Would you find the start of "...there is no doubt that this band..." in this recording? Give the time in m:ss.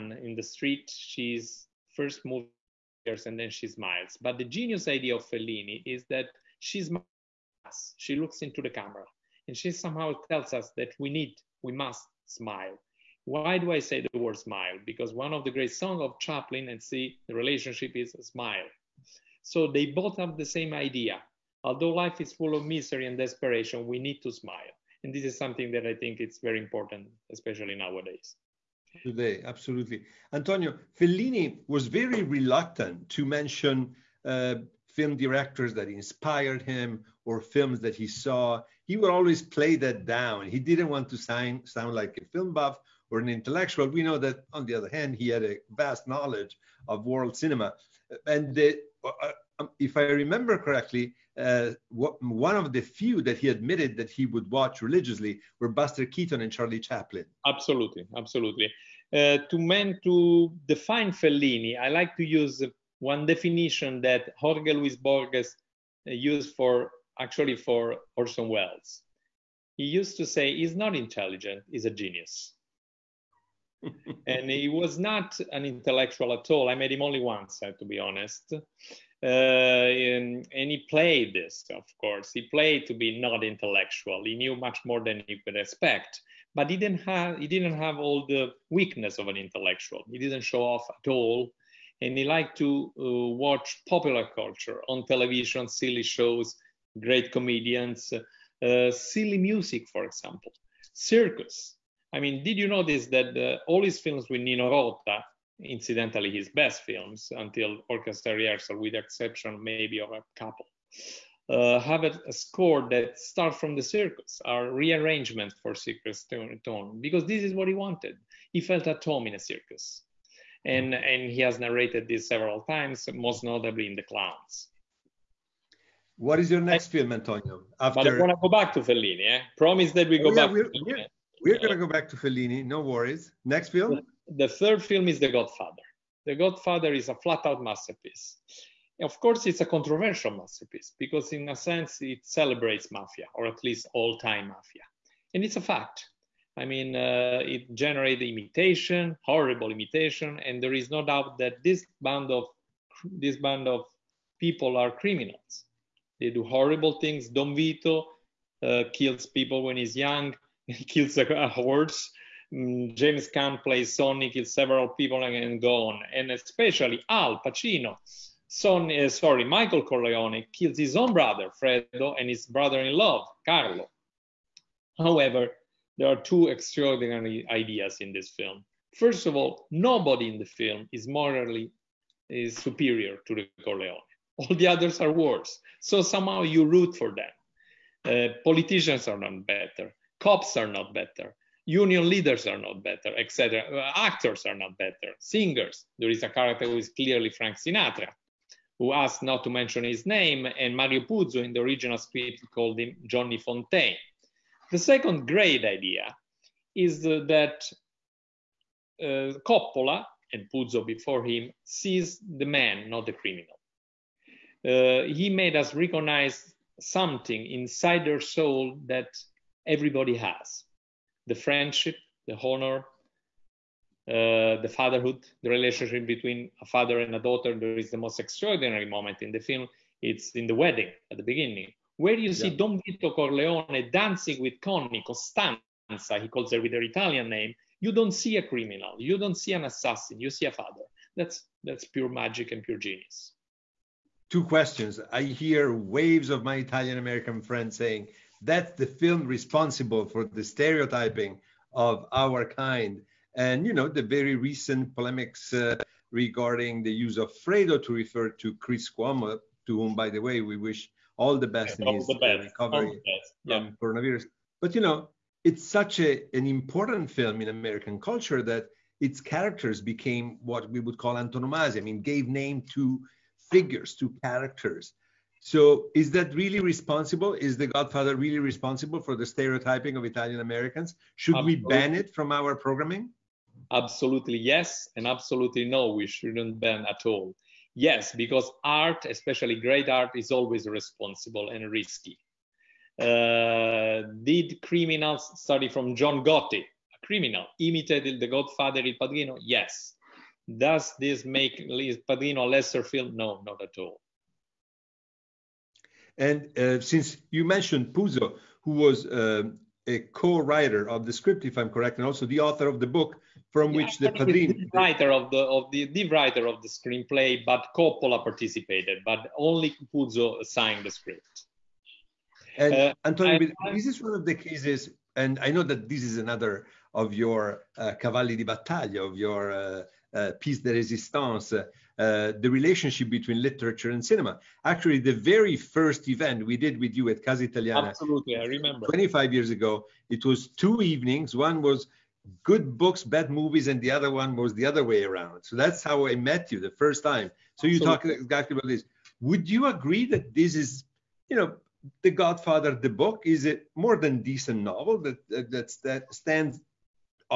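2:30.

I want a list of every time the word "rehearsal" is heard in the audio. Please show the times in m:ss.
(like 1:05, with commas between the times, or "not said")
1:48.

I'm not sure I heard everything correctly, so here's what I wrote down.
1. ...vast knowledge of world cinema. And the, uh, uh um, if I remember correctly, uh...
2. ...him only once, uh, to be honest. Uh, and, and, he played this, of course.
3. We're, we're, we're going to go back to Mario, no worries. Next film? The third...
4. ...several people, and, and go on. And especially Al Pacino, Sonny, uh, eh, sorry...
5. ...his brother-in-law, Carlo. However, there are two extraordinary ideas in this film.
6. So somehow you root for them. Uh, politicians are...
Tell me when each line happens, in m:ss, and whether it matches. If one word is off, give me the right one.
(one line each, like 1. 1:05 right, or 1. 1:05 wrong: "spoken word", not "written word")
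1. 0:45 right
2. 1:16 right
3. 2:10 wrong: "Fellini", not "Mario"
4. 2:44 right
5. 2:52 right
6. 3:05 right.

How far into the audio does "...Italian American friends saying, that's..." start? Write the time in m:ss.
4:06.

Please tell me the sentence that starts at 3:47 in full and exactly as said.
There is the most extraordinary moment in the film.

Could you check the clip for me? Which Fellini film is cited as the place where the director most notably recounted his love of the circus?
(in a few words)
The Clowns.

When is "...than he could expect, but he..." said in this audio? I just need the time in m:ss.
1:25.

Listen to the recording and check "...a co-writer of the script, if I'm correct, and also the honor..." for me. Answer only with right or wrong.
wrong.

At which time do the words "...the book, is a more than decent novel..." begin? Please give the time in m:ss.
5:52.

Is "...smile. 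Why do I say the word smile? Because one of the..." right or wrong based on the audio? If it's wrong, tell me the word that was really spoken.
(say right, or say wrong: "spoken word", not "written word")
right.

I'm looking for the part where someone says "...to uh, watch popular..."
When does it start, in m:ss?
1:32.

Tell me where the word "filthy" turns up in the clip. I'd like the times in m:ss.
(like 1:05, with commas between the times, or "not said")
not said.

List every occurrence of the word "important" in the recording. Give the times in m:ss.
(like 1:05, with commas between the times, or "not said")
0:26, 4:26.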